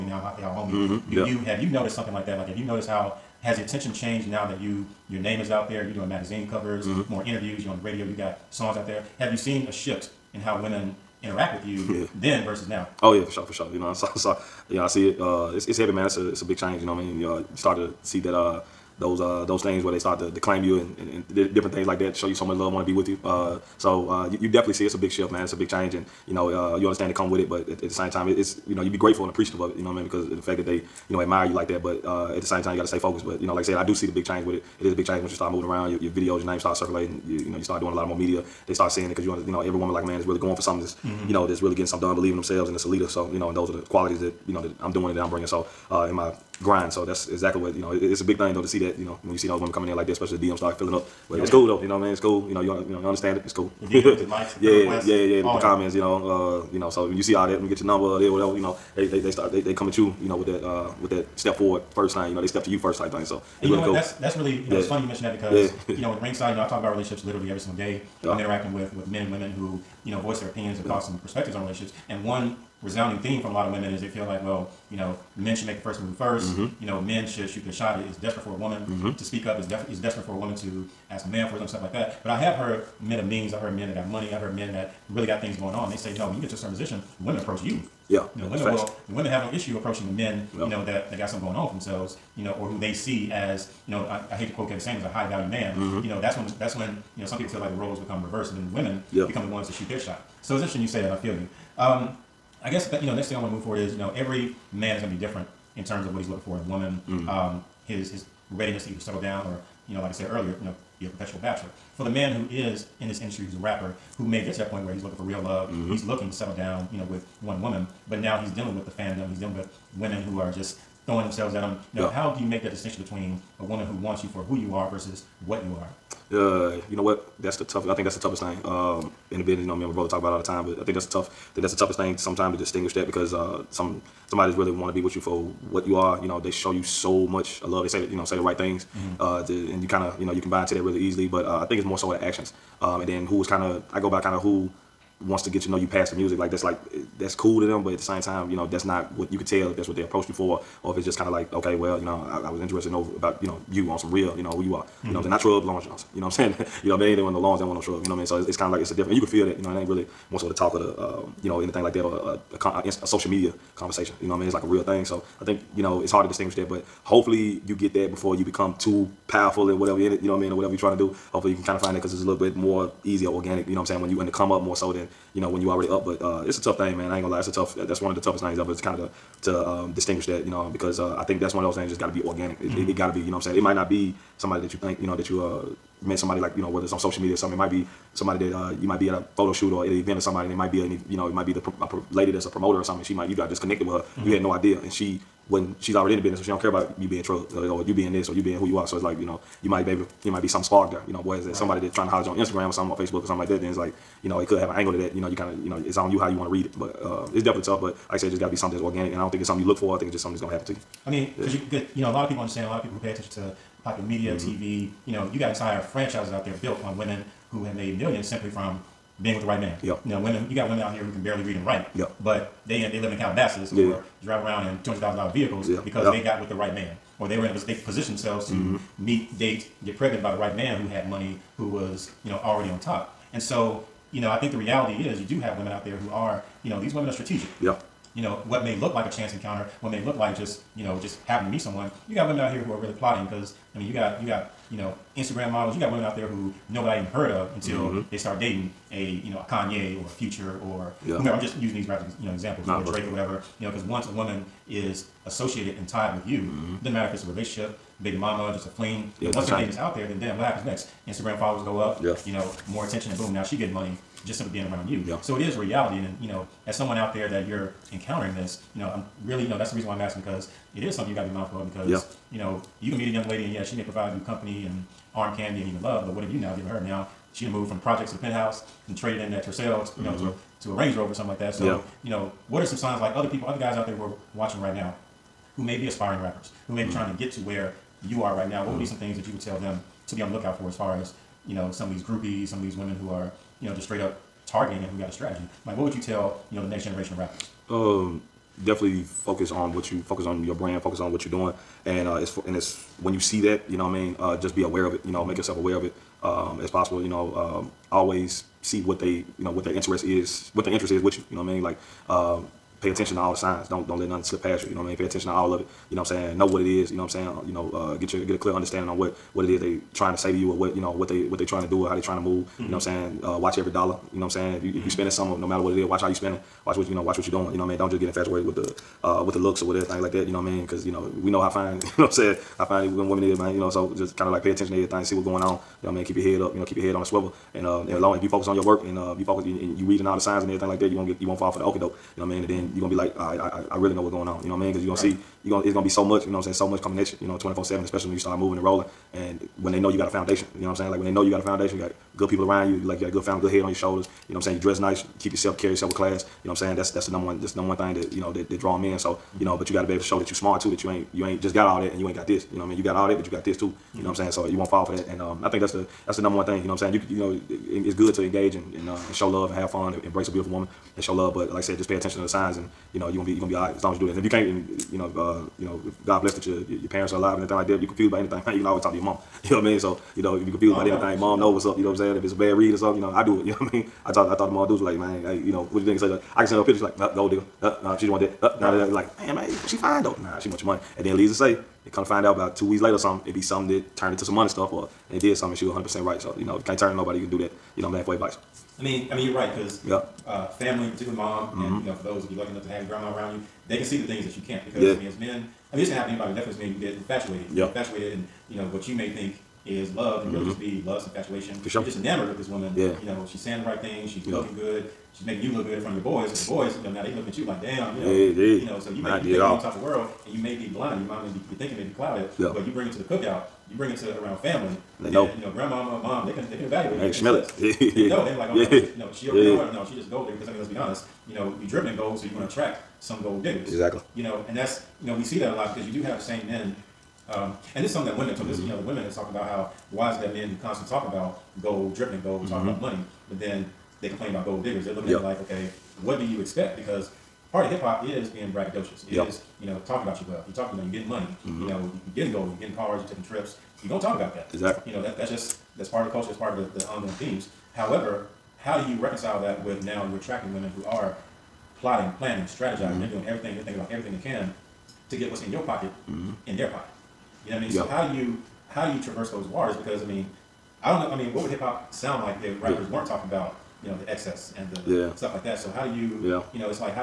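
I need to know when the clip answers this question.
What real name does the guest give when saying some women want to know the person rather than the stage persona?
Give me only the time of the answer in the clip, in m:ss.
2:35.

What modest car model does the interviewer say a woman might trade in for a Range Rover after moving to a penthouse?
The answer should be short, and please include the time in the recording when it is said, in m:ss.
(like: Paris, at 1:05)
Tercel, at 4:39.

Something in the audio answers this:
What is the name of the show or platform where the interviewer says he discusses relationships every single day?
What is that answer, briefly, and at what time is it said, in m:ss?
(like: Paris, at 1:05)
Ringside, at 1:06.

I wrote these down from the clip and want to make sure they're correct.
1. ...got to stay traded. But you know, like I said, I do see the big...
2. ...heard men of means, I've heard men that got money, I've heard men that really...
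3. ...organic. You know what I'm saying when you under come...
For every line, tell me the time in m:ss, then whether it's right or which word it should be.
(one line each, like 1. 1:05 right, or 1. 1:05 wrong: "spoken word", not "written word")
1. 0:32 wrong: "focused", not "traded"
2. 1:22 right
3. 2:53 right.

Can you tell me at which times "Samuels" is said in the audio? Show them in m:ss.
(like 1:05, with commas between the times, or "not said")
1:34.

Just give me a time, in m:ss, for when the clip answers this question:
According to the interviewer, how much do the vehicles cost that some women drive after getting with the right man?
3:44.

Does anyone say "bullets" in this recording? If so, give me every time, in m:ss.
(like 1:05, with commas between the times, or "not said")
not said.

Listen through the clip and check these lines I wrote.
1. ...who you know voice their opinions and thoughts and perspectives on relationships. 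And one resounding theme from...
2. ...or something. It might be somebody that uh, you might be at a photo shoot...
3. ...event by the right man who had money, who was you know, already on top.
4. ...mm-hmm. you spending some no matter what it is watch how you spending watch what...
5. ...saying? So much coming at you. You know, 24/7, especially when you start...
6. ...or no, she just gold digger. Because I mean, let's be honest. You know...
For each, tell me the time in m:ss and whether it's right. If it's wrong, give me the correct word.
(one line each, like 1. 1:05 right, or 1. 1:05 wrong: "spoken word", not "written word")
1. 1:09 right
2. 3:07 right
3. 3:49 wrong: "pregnant", not "event"
4. 5:24 right
5. 5:46 right
6. 7:09 right.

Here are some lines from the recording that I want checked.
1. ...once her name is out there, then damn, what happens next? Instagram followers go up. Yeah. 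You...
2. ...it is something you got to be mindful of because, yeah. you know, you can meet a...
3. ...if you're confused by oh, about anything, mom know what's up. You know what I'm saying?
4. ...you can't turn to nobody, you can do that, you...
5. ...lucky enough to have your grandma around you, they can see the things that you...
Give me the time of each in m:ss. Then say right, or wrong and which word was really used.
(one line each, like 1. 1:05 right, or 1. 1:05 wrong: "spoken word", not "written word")
1. 4:19 right
2. 4:30 right
3. 6:20 right
4. 6:36 right
5. 6:42 right.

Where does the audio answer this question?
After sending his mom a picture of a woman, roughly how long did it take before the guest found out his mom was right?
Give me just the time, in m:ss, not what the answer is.
6:32.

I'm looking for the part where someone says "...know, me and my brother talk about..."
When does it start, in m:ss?
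2:09.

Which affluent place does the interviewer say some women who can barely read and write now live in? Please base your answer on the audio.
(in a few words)
Calabasas.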